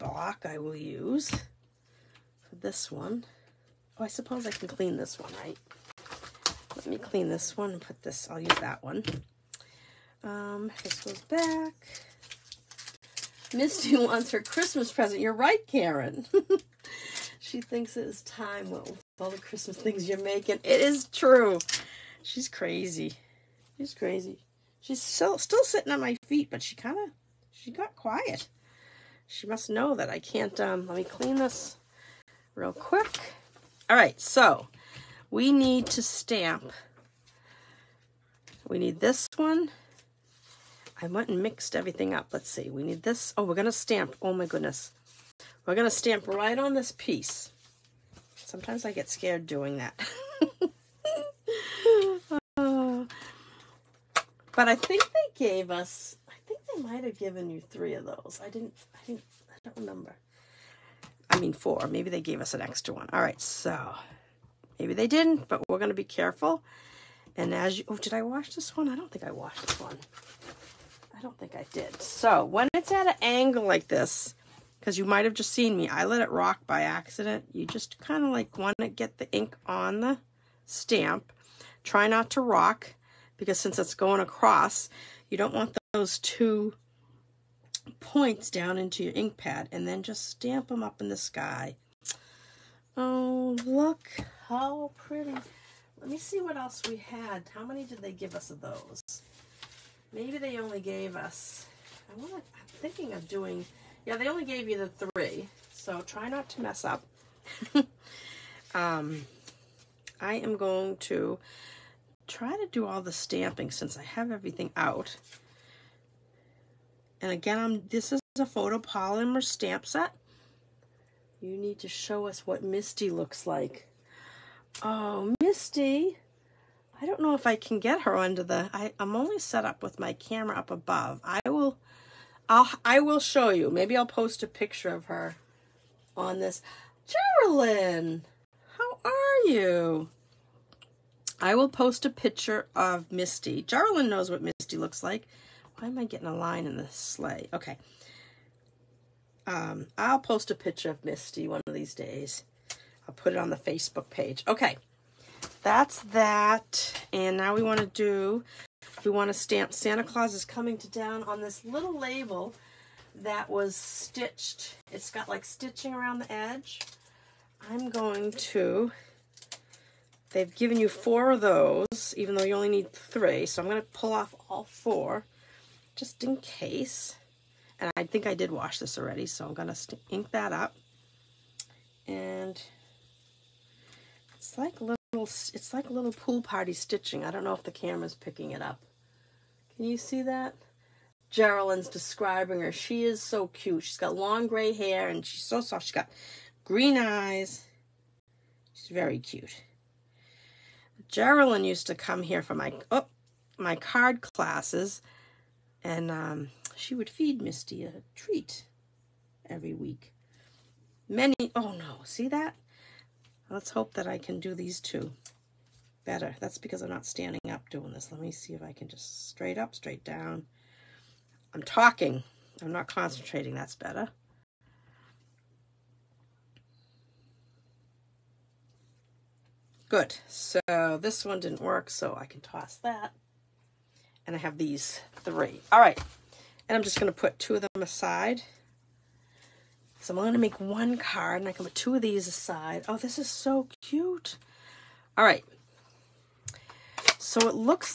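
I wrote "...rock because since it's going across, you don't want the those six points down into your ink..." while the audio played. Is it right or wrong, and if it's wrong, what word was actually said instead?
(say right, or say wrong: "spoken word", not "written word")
wrong: "two", not "six".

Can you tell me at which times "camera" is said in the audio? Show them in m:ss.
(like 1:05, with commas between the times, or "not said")
2:10, 3:07.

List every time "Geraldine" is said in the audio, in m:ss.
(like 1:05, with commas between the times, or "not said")
2:17, 3:11, 3:21.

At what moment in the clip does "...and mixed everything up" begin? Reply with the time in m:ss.
0:41.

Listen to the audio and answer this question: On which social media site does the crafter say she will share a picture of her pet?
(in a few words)
Facebook.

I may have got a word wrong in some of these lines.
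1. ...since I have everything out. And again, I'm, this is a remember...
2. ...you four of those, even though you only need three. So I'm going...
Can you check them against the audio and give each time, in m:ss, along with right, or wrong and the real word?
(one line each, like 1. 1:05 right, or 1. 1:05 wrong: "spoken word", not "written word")
1. 1:53 wrong: "photopolymer", not "remember"
2. 2:50 right.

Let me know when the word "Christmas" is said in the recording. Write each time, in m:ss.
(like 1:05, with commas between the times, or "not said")
0:14, 0:19.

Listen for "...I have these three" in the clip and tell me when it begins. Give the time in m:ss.
3:54.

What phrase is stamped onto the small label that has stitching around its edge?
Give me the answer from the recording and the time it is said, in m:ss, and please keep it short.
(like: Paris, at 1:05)
Santa Claus is coming to town, at 2:39.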